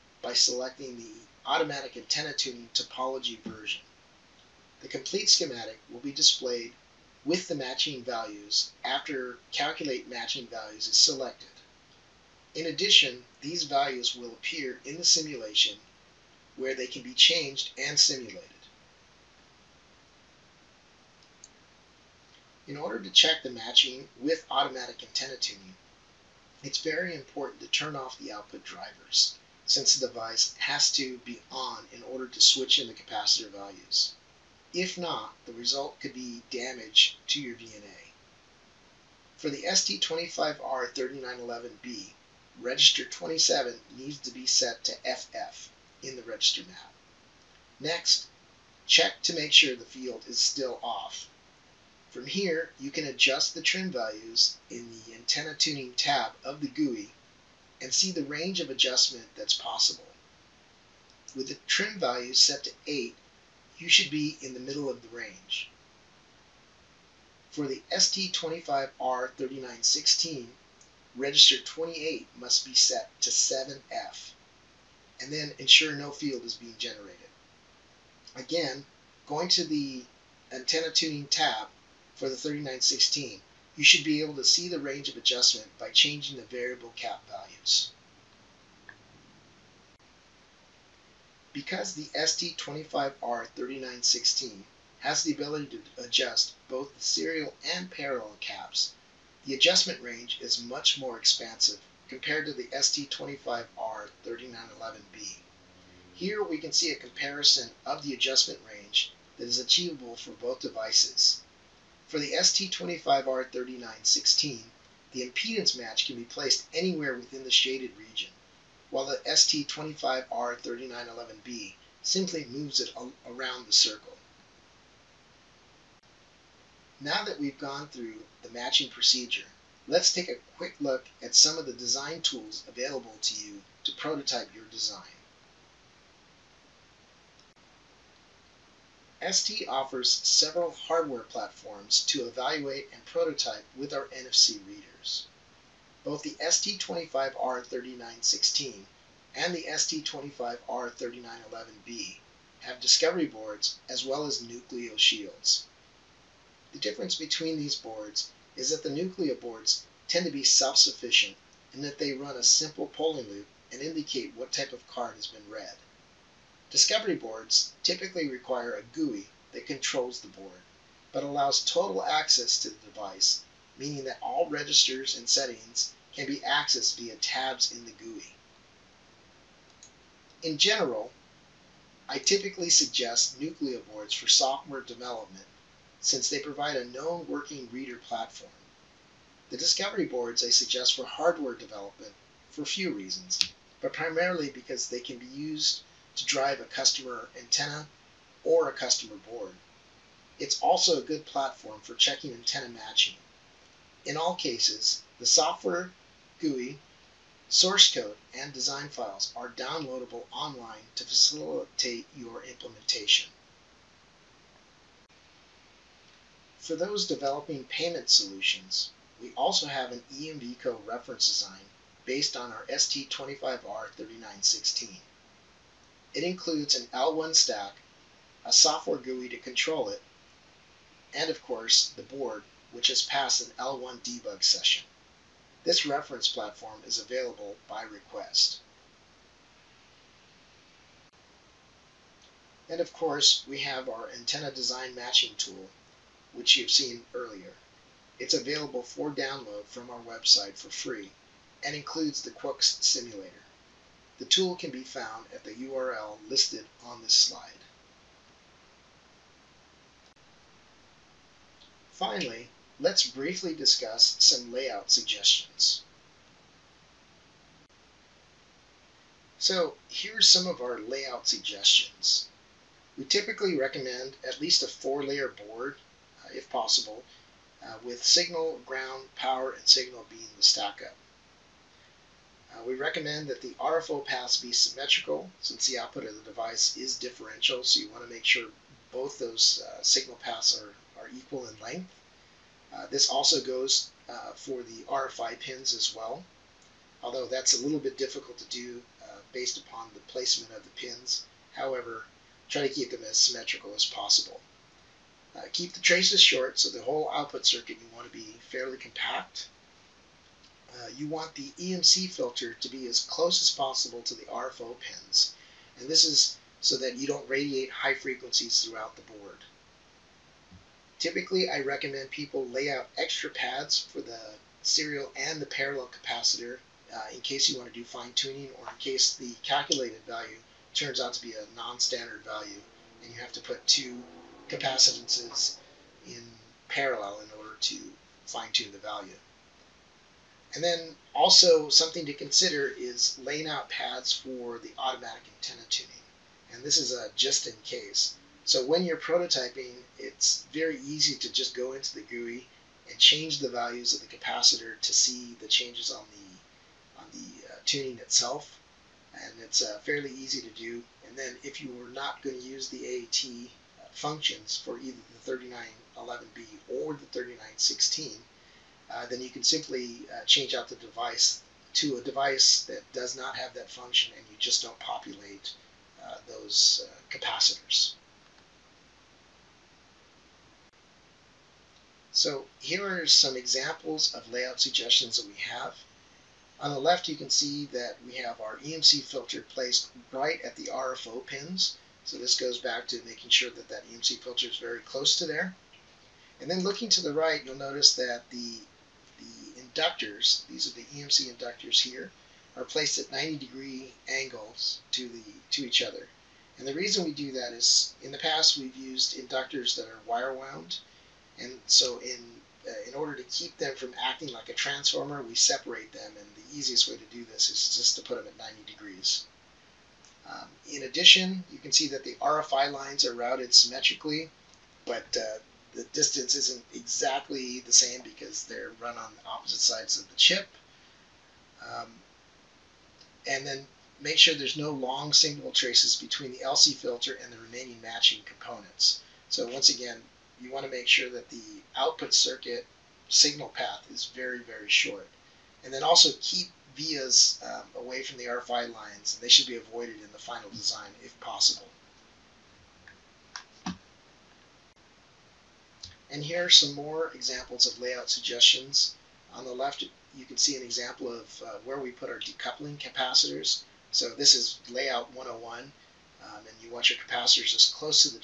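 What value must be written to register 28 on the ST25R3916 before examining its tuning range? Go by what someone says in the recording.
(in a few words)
7F.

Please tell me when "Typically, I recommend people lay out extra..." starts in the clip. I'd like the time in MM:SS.
05:21.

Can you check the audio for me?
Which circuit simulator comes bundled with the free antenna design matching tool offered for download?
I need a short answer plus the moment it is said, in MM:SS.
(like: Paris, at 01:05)
Qucs, at 04:12.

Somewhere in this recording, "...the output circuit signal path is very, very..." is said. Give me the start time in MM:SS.
07:21.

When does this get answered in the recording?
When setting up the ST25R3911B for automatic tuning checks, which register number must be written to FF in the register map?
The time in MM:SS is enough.
00:42.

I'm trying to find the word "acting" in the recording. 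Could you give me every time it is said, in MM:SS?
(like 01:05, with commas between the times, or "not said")
06:53.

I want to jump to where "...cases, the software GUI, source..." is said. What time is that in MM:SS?
03:24.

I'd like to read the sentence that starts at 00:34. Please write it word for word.
If not, the result could be damage to your VNA.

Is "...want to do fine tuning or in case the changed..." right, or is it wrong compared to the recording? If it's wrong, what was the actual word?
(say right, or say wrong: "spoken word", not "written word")
wrong: "calculated", not "changed".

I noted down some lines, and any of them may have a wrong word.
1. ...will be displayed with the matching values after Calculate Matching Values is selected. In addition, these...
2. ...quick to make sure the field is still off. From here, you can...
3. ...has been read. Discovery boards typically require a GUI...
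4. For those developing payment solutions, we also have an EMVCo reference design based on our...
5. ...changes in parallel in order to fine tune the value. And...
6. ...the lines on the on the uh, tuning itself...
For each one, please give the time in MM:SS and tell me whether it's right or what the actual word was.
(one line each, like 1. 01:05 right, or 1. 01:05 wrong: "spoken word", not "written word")
1. 00:05 right
2. 00:48 wrong: "check", not "quick"
3. 02:45 right
4. 03:36 right
5. 05:34 wrong: "capacitances", not "changes"
6. 05:55 wrong: "changes", not "lines".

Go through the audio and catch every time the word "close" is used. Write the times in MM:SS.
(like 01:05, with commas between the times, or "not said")
05:13, 06:34, 07:47.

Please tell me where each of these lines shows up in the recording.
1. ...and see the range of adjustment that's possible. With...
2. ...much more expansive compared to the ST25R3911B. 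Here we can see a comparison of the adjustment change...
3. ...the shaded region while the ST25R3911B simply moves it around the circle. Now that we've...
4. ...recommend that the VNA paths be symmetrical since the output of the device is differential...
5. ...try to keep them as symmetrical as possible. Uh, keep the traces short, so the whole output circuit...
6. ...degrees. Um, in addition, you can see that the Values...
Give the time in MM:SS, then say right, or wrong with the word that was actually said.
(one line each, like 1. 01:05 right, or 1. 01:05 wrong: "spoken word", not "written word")
1. 00:57 right
2. 01:40 wrong: "range", not "change"
3. 01:57 right
4. 04:42 wrong: "RFO", not "VNA"
5. 05:02 right
6. 06:58 wrong: "RFI", not "Values".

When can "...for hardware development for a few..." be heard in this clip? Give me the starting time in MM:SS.
03:10.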